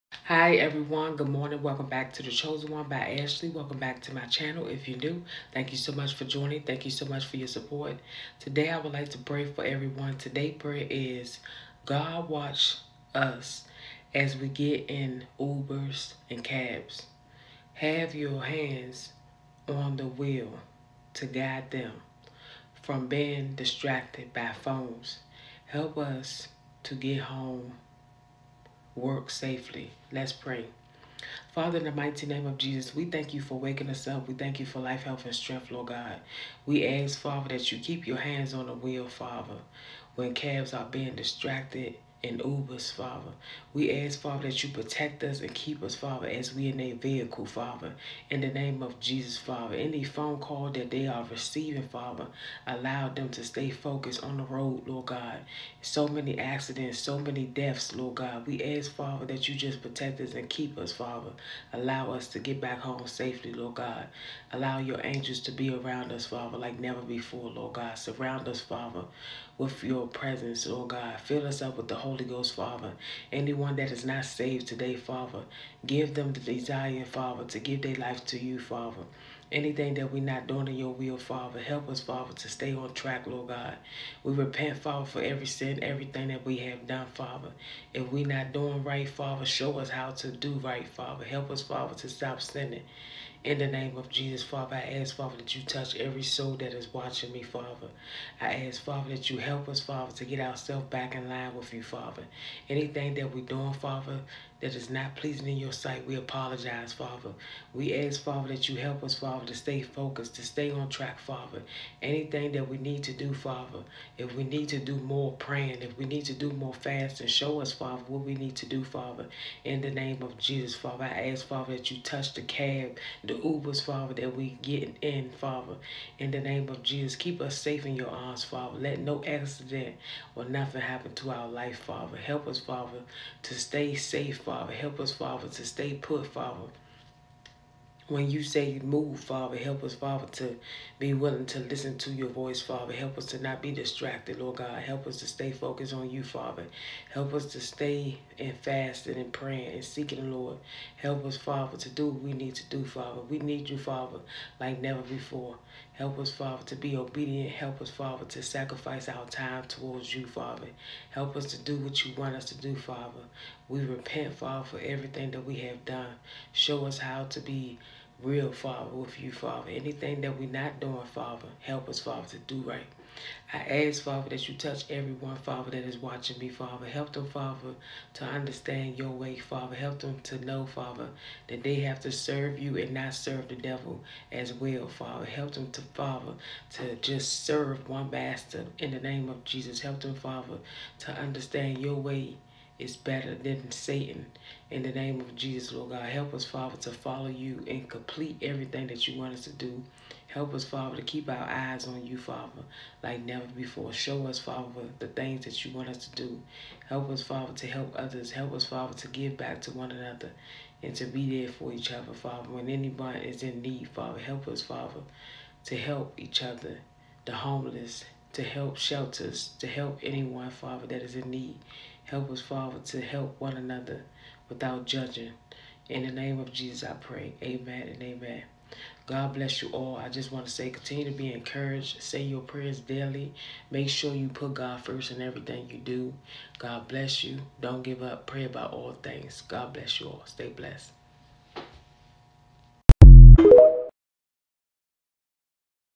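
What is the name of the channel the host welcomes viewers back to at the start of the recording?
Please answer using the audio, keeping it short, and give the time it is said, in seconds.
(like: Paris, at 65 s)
The Chosen One by Ashley, at 2 s.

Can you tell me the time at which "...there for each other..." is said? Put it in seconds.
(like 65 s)
211 s.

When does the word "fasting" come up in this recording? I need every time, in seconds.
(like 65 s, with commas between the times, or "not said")
116 s, 148 s.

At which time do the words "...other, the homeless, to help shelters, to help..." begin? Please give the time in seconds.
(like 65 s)
216 s.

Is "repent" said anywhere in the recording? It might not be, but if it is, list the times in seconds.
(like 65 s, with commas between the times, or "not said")
84 s, 163 s.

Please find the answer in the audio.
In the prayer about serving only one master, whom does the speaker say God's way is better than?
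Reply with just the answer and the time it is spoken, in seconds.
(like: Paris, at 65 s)
Satan, at 193 s.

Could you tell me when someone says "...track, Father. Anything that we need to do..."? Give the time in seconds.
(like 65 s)
110 s.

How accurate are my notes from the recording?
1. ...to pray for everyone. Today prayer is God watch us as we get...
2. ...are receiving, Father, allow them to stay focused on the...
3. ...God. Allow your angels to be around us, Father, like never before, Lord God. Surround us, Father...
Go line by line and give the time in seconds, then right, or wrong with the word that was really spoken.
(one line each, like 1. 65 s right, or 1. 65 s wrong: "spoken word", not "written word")
1. 9 s right
2. 51 s right
3. 63 s right.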